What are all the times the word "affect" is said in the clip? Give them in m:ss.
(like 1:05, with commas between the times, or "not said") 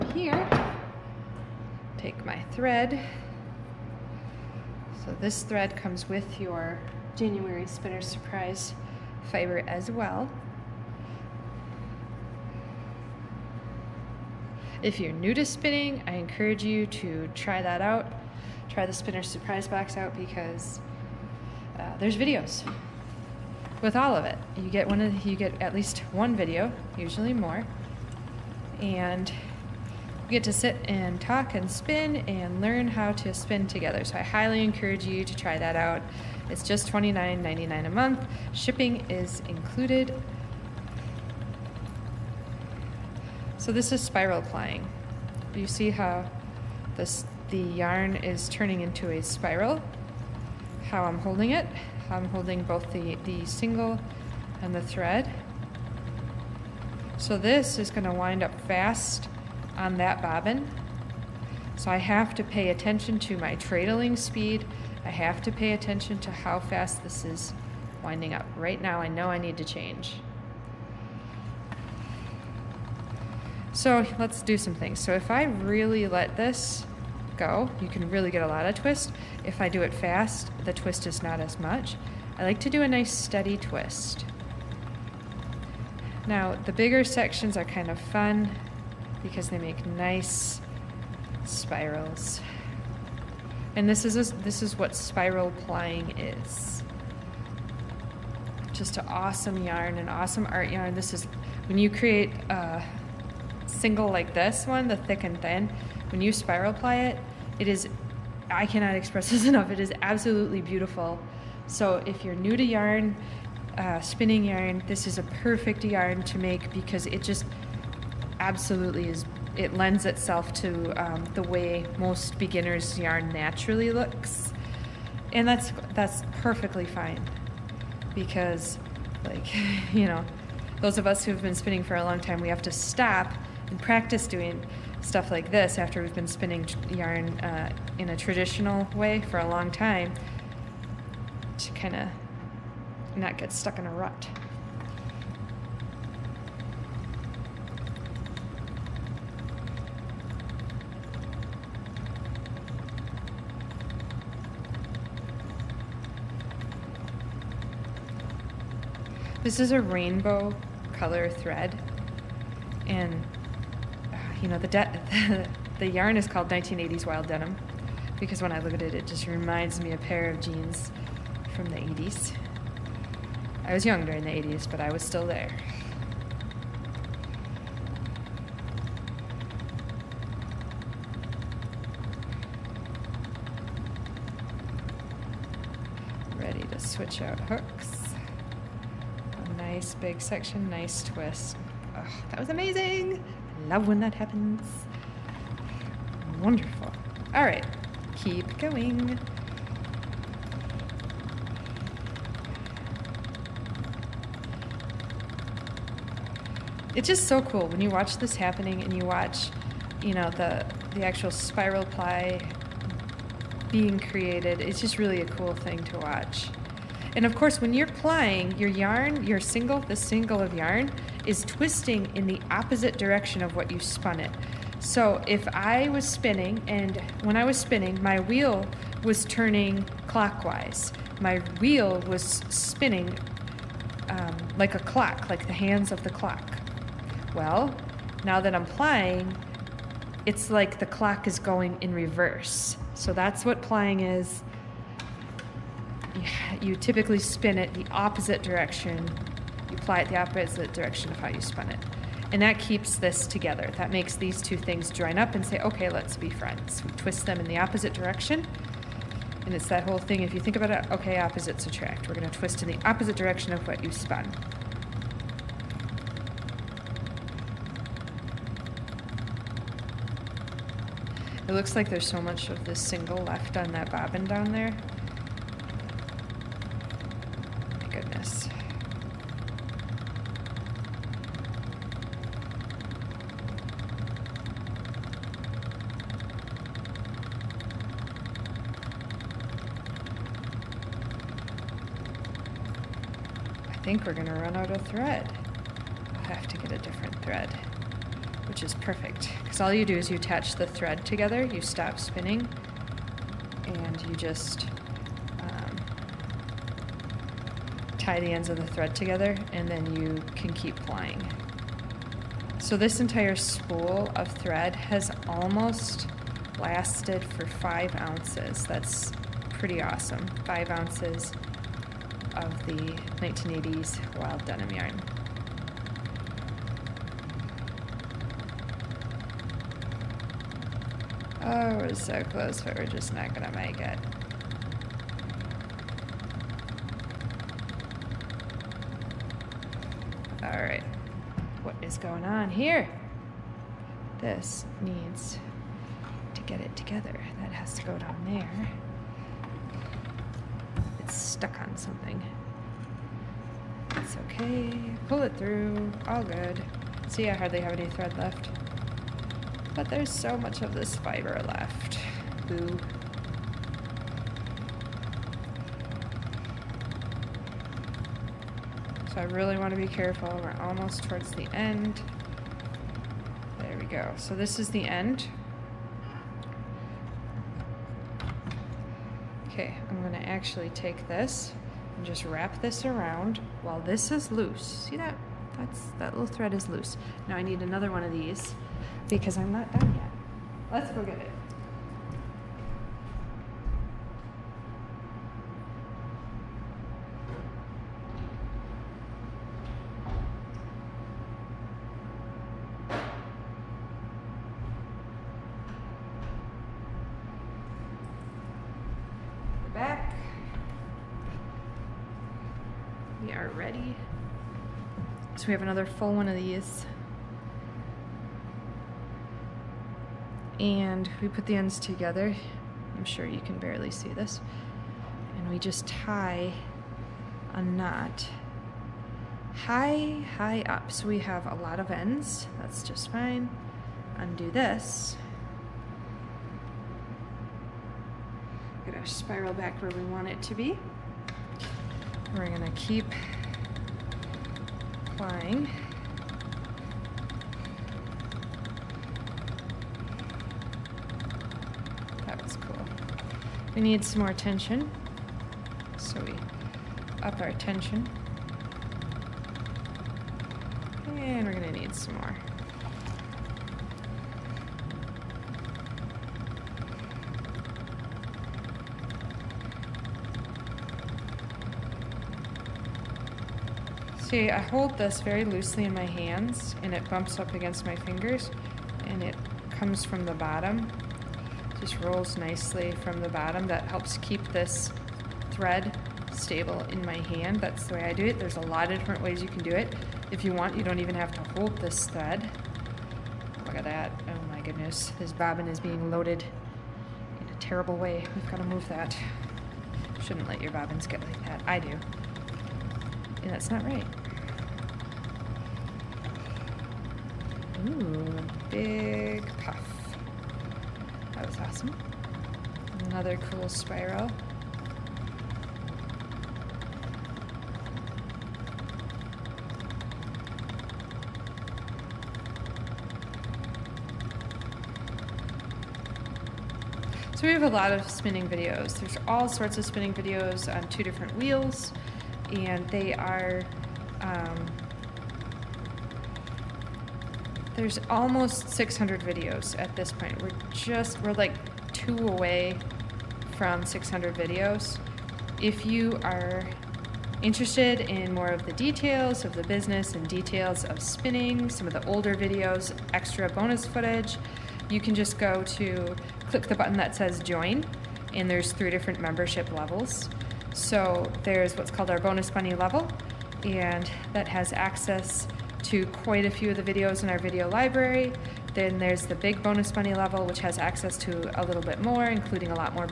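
not said.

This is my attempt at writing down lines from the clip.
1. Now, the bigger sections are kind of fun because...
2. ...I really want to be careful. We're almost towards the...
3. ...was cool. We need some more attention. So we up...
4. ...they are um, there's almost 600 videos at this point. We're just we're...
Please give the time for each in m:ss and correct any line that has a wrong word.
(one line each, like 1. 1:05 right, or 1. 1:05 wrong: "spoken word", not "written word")
1. 1:26 right
2. 6:09 right
3. 7:32 wrong: "tension", not "attention"
4. 8:52 right.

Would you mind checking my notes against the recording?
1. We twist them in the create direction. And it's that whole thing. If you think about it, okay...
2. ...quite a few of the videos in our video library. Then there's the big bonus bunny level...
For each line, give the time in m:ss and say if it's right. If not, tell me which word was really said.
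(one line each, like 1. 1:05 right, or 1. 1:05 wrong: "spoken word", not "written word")
1. 4:16 wrong: "opposite", not "create"
2. 9:26 right.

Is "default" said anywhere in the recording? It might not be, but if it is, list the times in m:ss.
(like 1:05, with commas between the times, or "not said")
not said.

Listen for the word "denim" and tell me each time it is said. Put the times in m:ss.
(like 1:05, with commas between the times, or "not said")
2:47, 5:24.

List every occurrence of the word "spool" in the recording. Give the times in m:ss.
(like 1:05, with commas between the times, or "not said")
5:13.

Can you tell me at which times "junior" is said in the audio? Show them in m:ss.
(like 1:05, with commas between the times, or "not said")
not said.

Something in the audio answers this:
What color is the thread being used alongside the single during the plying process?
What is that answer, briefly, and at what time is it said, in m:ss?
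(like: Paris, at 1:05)
rainbow, at 2:39.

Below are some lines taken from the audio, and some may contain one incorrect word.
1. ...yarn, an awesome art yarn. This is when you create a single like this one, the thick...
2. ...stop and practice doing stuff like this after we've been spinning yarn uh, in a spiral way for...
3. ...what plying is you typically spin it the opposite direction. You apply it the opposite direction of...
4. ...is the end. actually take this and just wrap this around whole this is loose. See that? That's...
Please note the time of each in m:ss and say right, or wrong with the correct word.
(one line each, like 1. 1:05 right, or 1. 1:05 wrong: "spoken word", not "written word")
1. 1:39 right
2. 2:12 wrong: "traditional", not "spiral"
3. 4:03 right
4. 6:14 wrong: "while", not "whole".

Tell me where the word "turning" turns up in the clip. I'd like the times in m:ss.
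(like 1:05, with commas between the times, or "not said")
0:48, 3:49.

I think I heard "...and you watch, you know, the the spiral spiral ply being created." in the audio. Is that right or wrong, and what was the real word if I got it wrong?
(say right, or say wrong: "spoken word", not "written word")
wrong: "actual", not "spiral".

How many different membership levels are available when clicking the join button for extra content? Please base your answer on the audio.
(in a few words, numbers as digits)
3.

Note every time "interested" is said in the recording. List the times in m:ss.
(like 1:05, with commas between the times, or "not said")
9:07.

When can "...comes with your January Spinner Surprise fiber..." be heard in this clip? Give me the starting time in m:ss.
0:05.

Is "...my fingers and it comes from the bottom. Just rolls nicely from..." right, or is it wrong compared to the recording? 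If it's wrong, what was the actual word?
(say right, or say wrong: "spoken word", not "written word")
right.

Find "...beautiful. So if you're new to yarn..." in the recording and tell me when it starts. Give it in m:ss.
1:50.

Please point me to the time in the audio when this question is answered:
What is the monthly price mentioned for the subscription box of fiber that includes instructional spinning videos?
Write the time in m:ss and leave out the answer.
0:36.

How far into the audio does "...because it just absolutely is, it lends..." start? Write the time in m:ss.
1:56.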